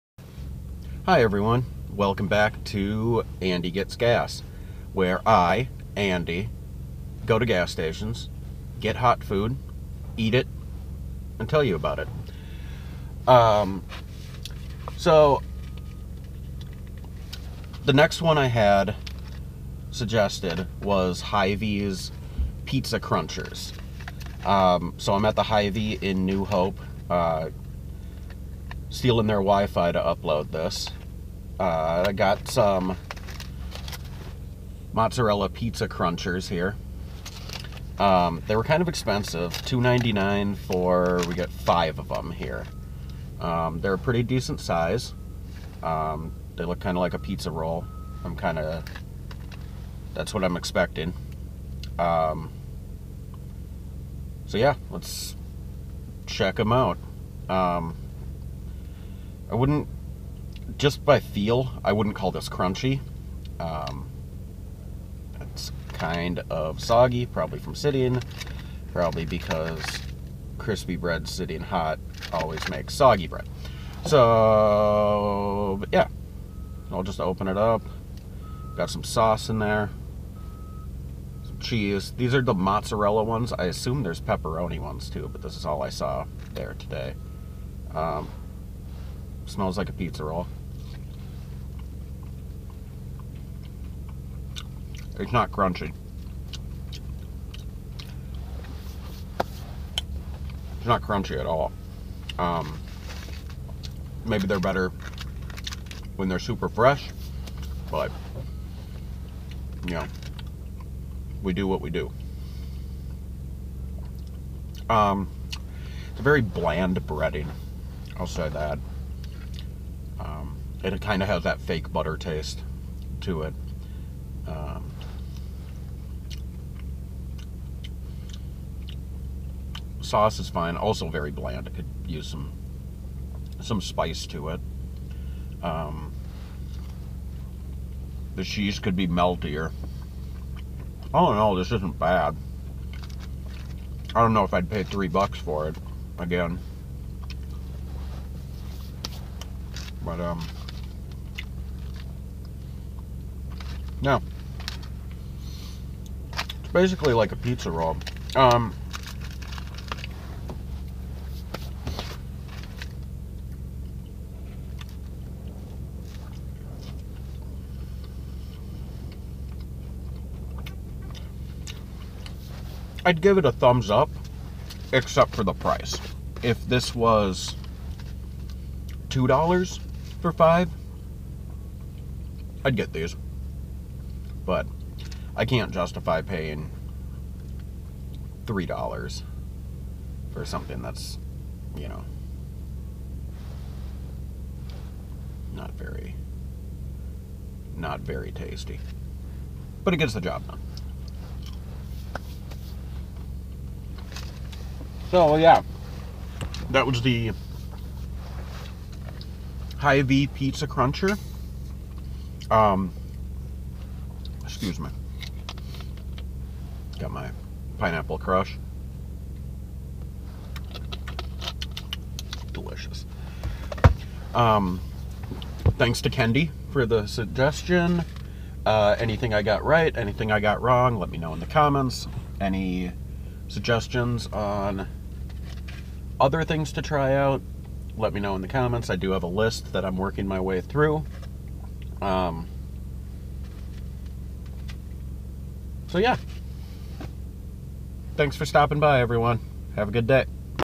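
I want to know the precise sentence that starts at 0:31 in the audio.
Uh, I got some mozzarella pizza crunchers here.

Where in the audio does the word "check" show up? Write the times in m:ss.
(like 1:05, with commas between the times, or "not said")
0:56.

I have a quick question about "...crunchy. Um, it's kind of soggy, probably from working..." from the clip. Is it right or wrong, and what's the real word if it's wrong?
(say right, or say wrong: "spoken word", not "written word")
wrong: "sitting", not "working".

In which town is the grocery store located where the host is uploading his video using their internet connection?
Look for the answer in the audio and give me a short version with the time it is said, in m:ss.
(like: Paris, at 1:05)
New Hope, at 0:26.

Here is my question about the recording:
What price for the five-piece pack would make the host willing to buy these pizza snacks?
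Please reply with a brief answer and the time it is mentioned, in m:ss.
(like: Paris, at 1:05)
$2, at 2:59.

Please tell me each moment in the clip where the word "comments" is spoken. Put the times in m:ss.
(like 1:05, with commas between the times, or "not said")
3:51, 3:58.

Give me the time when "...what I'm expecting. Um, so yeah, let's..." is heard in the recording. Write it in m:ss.
0:50.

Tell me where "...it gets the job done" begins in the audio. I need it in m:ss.
3:19.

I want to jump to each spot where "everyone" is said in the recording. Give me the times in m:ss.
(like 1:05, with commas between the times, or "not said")
0:01, 4:08.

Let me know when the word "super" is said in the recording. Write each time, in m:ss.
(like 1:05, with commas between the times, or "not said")
1:46.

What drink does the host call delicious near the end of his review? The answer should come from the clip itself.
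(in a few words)
pineapple crush.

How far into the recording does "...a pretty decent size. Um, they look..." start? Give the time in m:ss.
0:43.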